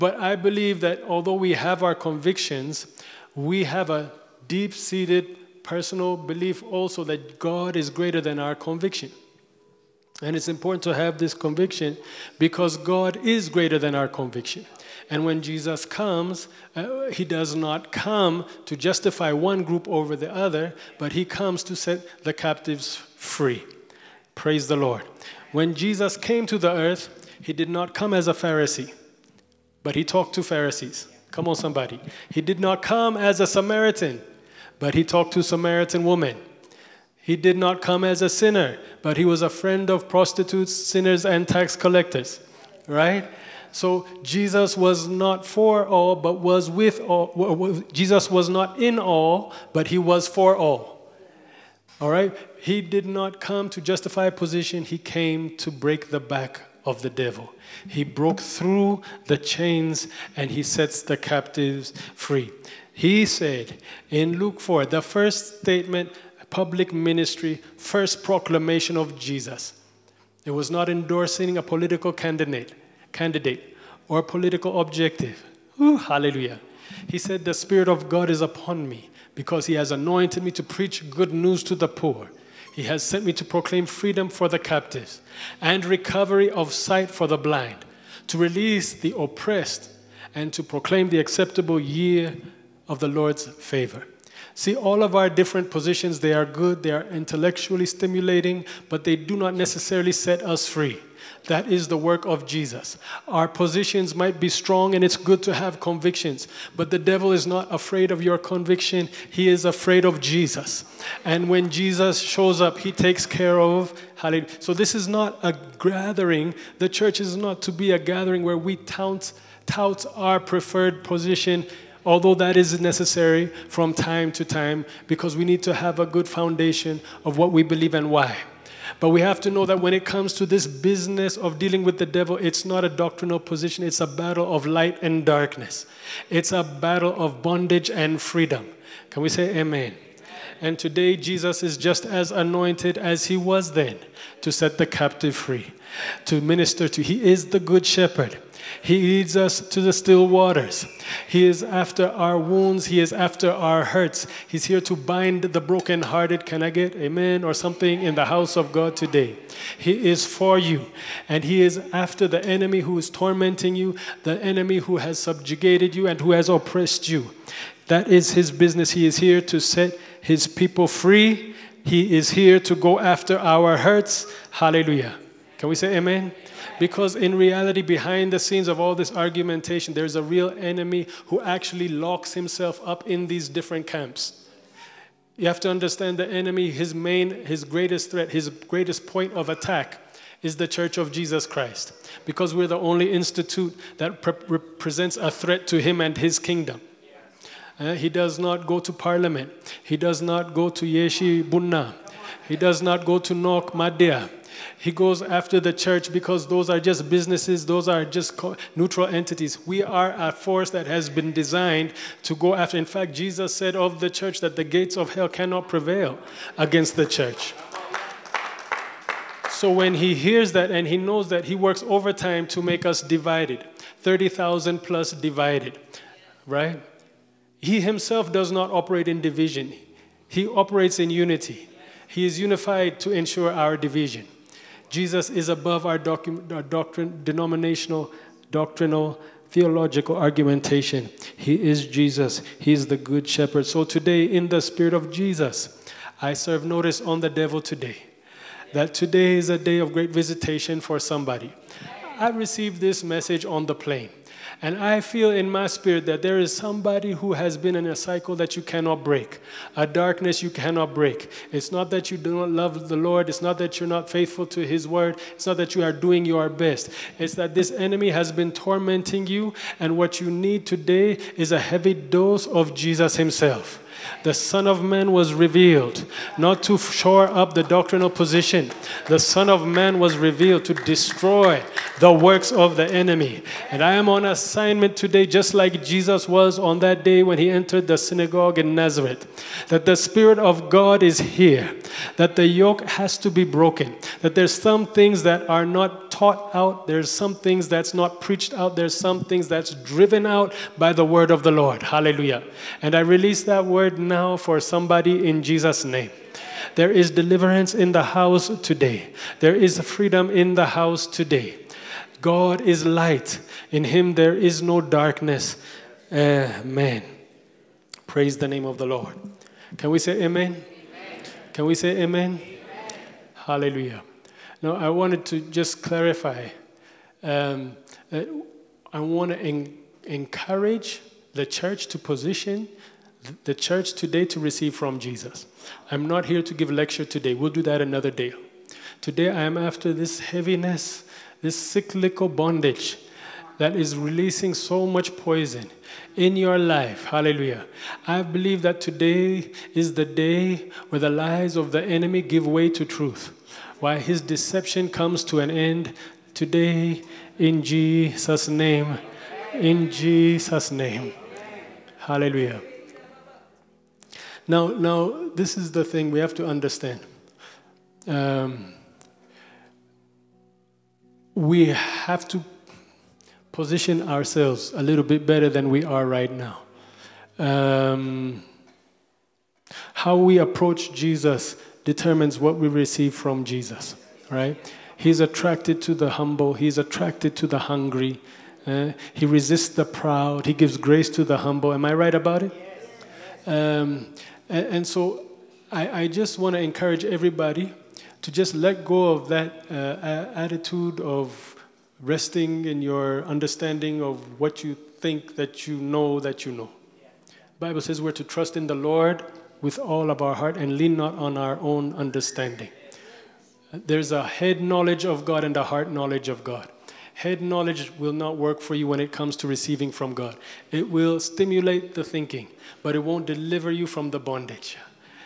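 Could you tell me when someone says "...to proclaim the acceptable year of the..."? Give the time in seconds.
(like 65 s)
90 s.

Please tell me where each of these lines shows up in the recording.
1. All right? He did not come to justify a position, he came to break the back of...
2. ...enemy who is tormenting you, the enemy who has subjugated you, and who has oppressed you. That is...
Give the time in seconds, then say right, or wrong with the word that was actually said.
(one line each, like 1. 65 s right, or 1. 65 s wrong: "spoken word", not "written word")
1. 52 s right
2. 162 s right.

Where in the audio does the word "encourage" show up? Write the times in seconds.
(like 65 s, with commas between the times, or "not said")
330 s, 396 s.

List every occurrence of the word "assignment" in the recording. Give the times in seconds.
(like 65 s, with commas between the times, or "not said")
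284 s.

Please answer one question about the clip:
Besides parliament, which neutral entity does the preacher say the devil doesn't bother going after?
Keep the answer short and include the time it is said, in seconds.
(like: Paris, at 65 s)
Yeshi Bunna, at 200 s.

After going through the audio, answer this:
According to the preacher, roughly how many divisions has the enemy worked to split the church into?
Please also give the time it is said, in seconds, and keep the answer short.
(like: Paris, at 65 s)
30,000, at 224 s.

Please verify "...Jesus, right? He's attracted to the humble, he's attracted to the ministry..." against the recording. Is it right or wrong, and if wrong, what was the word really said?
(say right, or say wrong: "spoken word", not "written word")
wrong: "hungry", not "ministry".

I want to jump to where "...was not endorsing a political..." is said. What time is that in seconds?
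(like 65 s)
70 s.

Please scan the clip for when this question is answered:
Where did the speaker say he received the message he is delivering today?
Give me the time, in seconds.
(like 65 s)
253 s.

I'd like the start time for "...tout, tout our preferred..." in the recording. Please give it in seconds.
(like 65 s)
118 s.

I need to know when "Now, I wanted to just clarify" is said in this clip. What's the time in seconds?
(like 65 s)
324 s.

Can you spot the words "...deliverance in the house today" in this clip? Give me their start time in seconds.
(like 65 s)
307 s.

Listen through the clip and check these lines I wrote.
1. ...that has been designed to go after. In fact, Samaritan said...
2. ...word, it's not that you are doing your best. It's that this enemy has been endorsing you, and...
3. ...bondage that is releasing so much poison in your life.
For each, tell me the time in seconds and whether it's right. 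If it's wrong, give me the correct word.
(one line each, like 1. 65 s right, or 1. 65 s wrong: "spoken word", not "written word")
1. 210 s wrong: "Jesus", not "Samaritan"
2. 264 s wrong: "tormenting", not "endorsing"
3. 342 s right.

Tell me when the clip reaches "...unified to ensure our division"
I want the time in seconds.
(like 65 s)
232 s.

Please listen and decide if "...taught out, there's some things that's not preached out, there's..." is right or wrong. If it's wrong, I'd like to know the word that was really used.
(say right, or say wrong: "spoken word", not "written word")
right.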